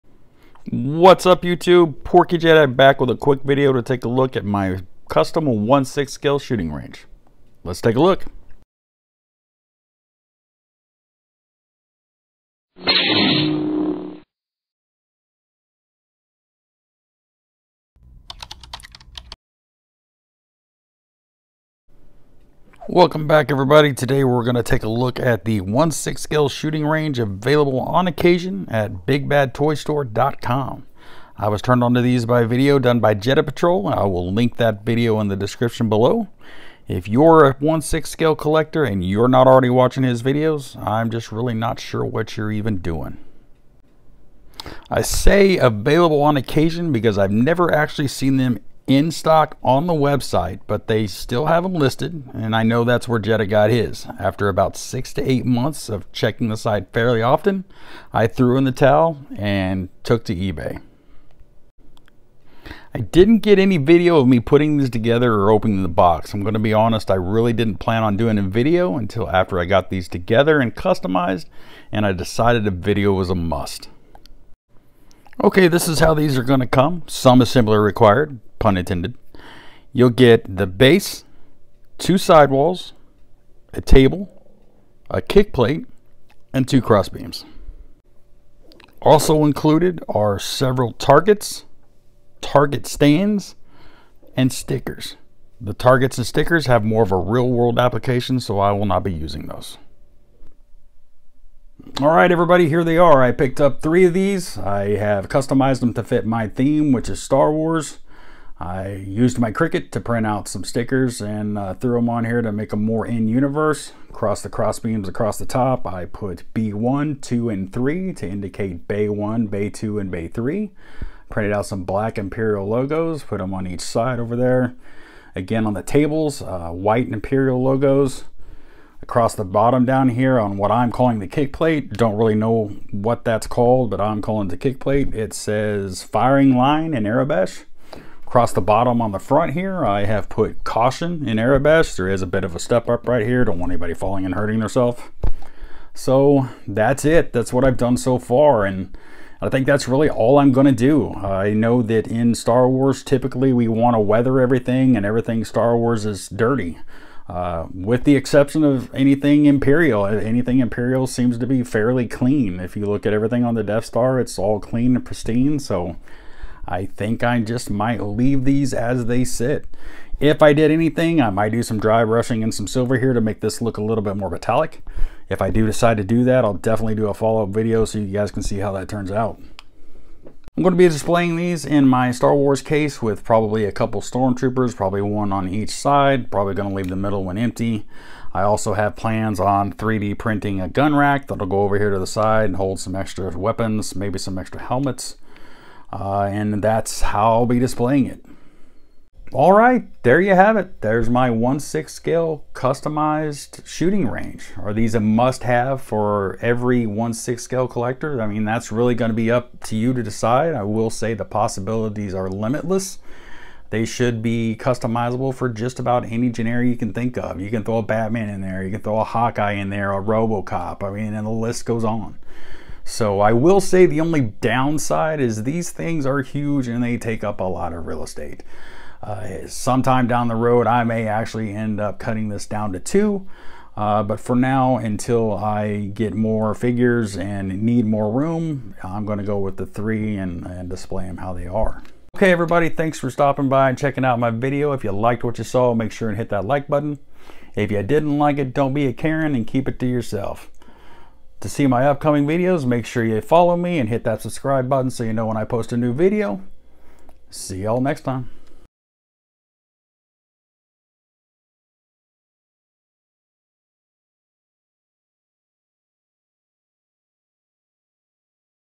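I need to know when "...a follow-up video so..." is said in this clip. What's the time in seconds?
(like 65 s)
177 s.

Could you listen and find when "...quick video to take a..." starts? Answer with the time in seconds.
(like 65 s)
3 s.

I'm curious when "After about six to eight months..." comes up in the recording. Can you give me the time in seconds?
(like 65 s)
54 s.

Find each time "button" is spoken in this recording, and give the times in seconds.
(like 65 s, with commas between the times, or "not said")
246 s, 254 s.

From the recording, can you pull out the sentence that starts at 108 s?
I used my Cricut to print out some stickers and uh, threw them on here to make them more in-universe.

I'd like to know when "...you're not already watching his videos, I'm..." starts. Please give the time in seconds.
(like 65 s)
39 s.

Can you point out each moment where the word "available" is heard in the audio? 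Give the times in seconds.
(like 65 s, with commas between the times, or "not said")
27 s, 45 s.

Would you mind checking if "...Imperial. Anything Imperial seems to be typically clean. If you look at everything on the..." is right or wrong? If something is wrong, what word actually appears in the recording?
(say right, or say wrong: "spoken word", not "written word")
wrong: "fairly", not "typically".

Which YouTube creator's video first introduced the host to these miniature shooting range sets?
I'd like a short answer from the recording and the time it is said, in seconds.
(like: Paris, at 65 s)
Jedha Patrol, at 33 s.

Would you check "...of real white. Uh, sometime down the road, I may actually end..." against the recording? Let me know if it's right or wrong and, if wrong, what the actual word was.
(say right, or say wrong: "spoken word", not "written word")
wrong: "estate", not "white".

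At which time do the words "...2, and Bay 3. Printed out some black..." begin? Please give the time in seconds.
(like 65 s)
119 s.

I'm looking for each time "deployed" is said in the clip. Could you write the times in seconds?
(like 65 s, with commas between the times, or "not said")
not said.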